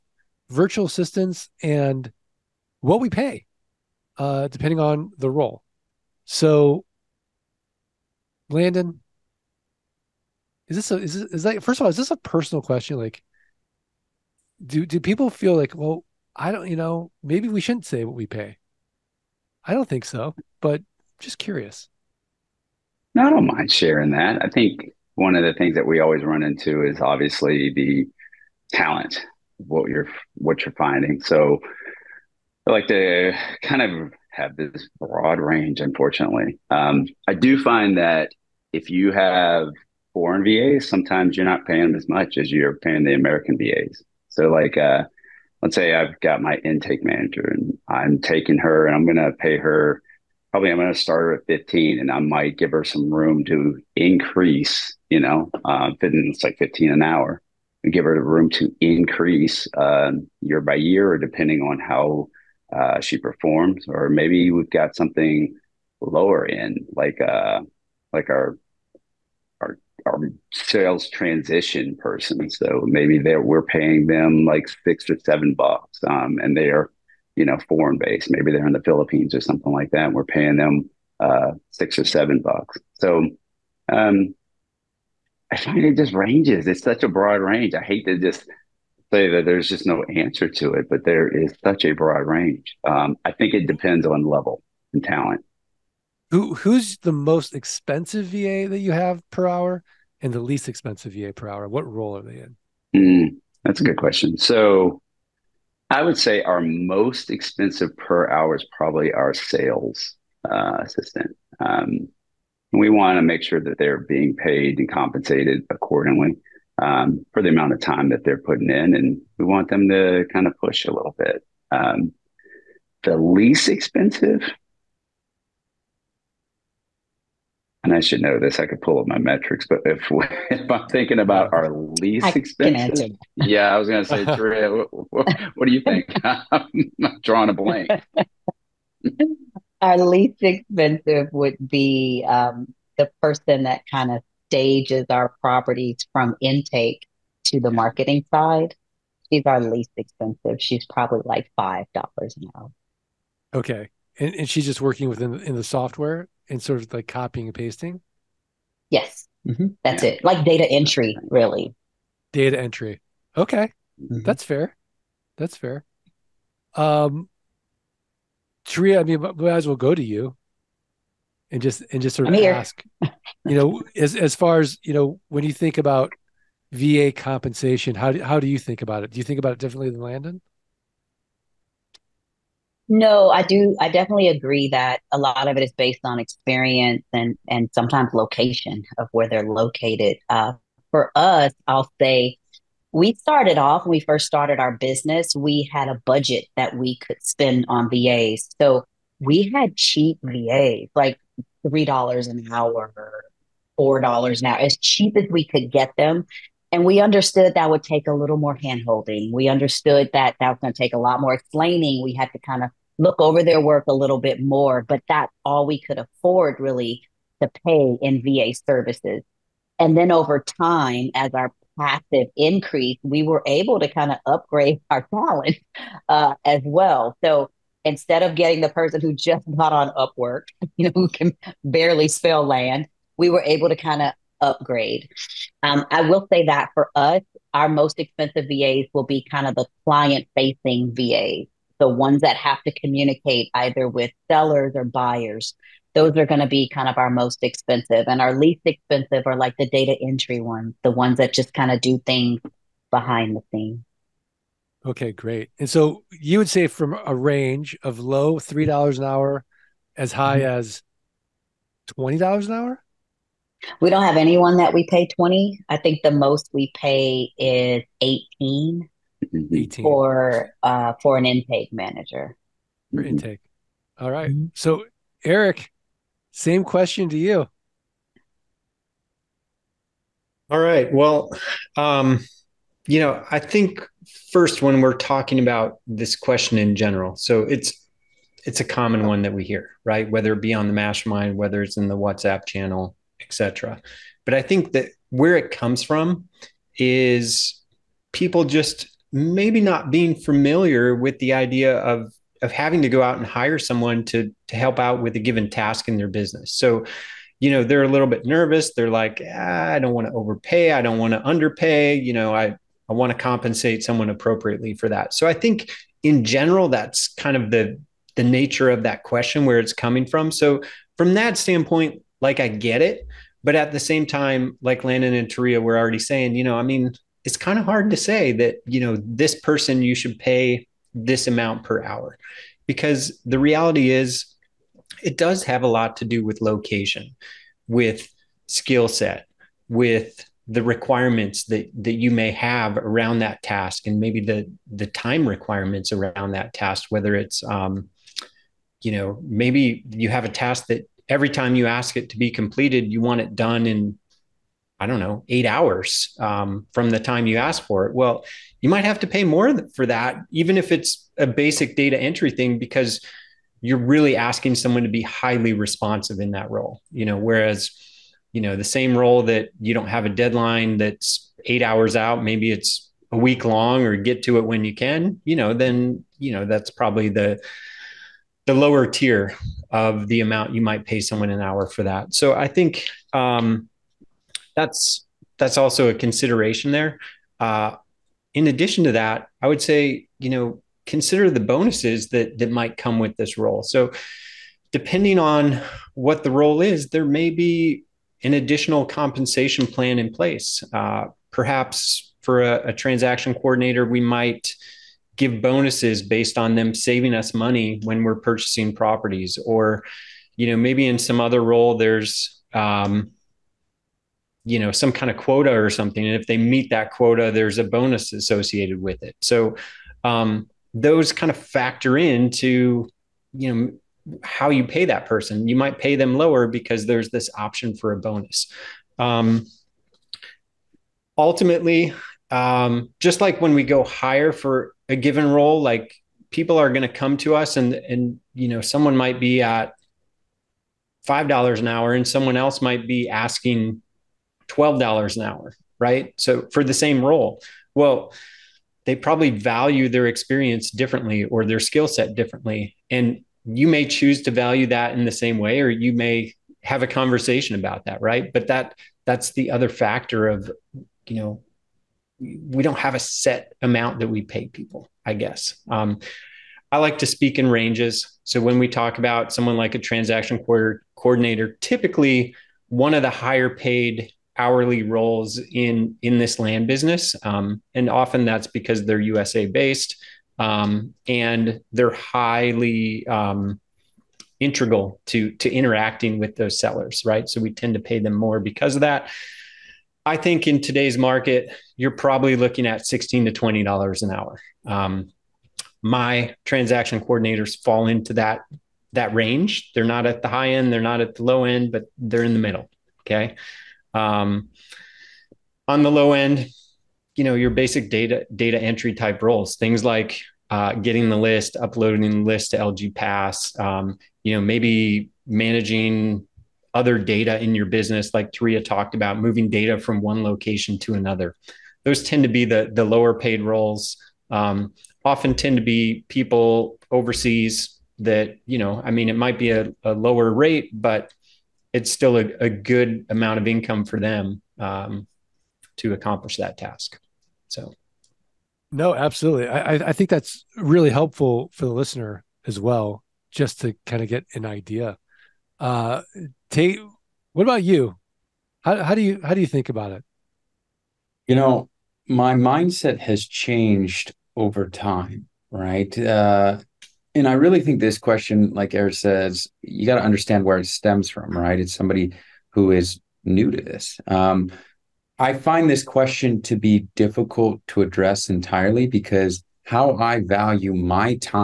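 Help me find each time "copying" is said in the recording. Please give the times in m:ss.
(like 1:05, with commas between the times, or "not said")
2:37.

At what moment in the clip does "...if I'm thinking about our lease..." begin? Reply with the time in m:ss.
2:10.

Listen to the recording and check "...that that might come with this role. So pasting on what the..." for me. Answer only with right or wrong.
wrong.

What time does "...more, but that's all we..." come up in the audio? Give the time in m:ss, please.
3:34.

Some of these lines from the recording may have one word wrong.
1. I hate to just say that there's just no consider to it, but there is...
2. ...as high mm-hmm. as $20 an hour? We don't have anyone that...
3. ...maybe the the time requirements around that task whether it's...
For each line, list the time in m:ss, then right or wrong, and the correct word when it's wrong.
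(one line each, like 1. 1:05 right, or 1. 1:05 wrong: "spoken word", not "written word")
1. 1:27 wrong: "answer", not "consider"
2. 4:19 right
3. 5:44 right.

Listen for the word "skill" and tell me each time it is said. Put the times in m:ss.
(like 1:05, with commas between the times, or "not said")
5:38, 7:31.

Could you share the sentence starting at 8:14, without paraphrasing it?
Um, my transaction coordinators fall into that that range.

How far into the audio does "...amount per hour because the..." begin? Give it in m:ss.
5:31.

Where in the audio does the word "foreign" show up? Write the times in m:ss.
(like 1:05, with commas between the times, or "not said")
0:40, 1:17.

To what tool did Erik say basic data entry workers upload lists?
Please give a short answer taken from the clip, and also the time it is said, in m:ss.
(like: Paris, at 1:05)
LG Pass, at 8:32.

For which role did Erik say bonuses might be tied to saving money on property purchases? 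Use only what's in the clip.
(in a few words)
transaction coordinator.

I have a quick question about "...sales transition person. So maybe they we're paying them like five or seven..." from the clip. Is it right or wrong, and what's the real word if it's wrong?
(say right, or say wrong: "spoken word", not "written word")
wrong: "six", not "five".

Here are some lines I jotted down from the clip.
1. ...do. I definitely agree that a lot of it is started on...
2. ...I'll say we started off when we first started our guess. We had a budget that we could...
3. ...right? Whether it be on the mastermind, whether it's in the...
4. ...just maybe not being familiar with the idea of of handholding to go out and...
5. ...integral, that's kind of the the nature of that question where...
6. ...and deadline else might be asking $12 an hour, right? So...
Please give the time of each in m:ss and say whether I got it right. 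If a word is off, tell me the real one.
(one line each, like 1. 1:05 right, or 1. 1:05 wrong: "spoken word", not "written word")
1. 3:03 wrong: "based", not "started"
2. 3:11 wrong: "business", not "guess"
3. 4:49 right
4. 4:58 wrong: "having", not "handholding"
5. 5:16 wrong: "general", not "integral"
6. 7:21 wrong: "someone", not "deadline".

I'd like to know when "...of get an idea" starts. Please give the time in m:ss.
9:04.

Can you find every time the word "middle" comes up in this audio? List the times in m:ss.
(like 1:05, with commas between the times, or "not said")
8:22.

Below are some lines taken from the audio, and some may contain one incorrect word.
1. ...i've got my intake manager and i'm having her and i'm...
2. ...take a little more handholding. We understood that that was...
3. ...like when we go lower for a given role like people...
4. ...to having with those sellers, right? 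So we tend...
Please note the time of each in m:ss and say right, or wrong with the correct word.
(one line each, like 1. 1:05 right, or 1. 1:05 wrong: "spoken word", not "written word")
1. 0:45 wrong: "taking", not "having"
2. 3:27 right
3. 7:13 wrong: "higher", not "lower"
4. 8:05 wrong: "interacting", not "having".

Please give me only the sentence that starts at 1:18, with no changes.
Maybe they're in the Philippines or something like that.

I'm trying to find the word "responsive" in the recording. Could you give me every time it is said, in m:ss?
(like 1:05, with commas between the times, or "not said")
6:05.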